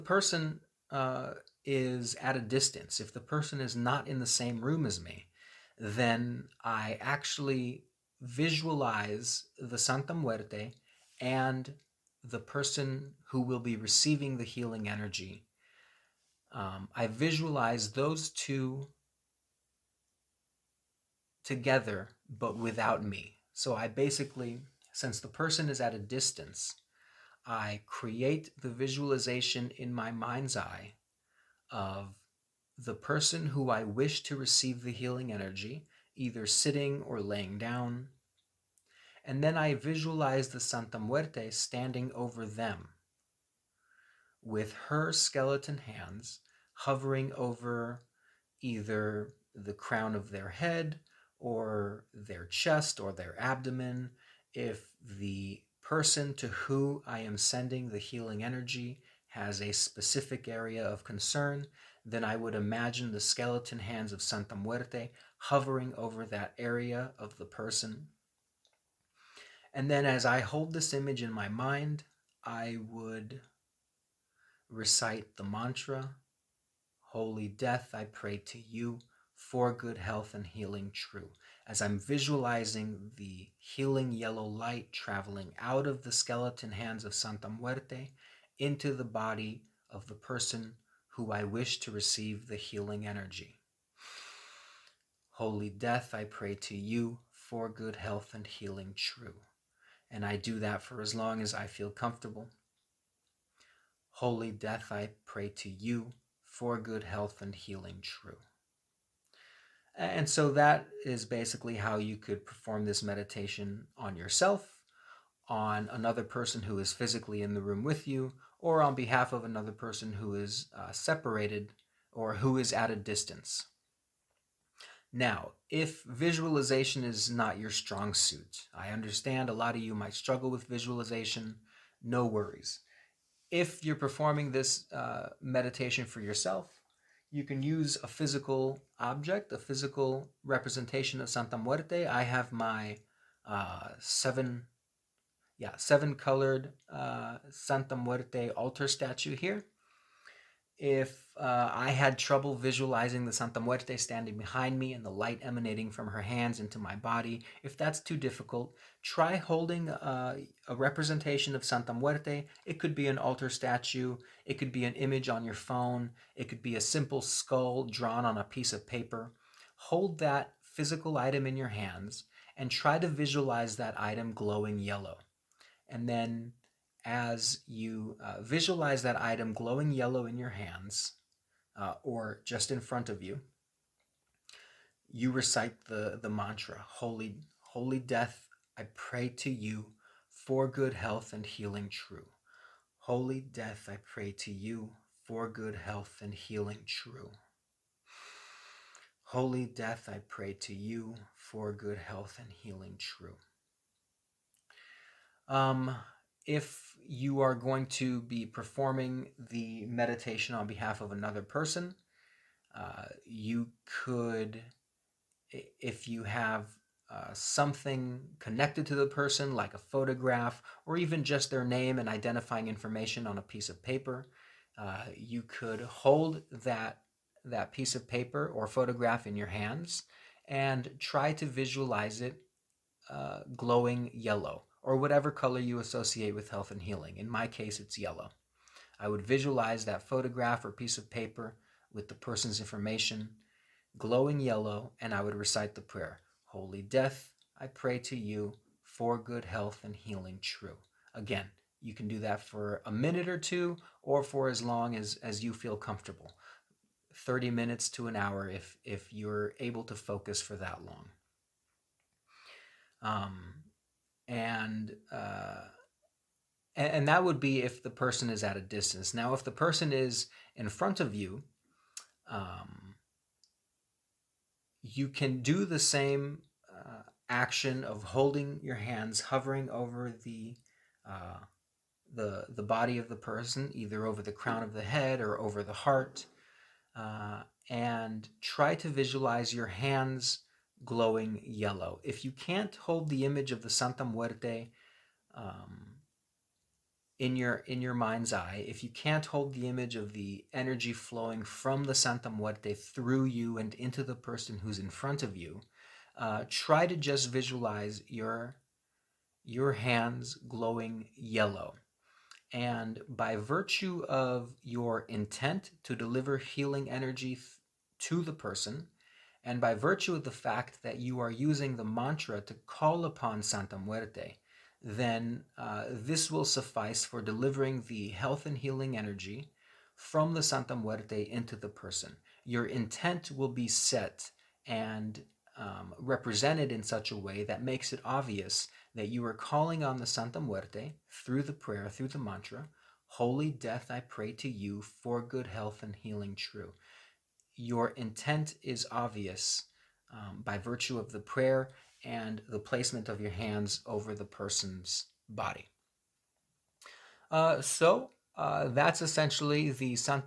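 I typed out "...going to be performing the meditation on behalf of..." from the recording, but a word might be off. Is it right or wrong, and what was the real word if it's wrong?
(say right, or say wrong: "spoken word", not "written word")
right.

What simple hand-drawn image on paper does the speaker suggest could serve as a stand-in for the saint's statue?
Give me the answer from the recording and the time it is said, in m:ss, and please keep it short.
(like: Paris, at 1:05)
a simple skull, at 2:46.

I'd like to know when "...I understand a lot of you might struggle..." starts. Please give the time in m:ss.
2:08.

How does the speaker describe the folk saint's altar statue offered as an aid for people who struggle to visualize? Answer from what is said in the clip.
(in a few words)
seven colored.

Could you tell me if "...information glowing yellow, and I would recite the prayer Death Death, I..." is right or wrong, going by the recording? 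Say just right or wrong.
wrong.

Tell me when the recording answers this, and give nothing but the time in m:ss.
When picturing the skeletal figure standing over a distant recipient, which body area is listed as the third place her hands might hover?
0:53.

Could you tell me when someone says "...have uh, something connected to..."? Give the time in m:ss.
3:36.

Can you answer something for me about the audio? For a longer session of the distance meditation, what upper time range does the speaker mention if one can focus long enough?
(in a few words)
30 minutes to an hour.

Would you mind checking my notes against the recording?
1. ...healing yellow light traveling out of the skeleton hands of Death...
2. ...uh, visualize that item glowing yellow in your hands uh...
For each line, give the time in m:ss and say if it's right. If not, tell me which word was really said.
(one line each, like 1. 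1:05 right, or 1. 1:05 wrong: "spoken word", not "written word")
1. 1:23 wrong: "Santa", not "Death"
2. 2:58 right.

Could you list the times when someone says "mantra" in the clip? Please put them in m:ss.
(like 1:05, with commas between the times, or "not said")
1:15, 3:06, 5:21, 5:42.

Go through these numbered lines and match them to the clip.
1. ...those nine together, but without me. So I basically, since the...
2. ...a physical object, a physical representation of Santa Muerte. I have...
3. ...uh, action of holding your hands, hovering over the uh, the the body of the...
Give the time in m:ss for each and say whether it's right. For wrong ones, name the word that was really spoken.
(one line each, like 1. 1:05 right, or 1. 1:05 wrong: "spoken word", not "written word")
1. 0:17 wrong: "two", not "nine"
2. 2:18 right
3. 4:36 right.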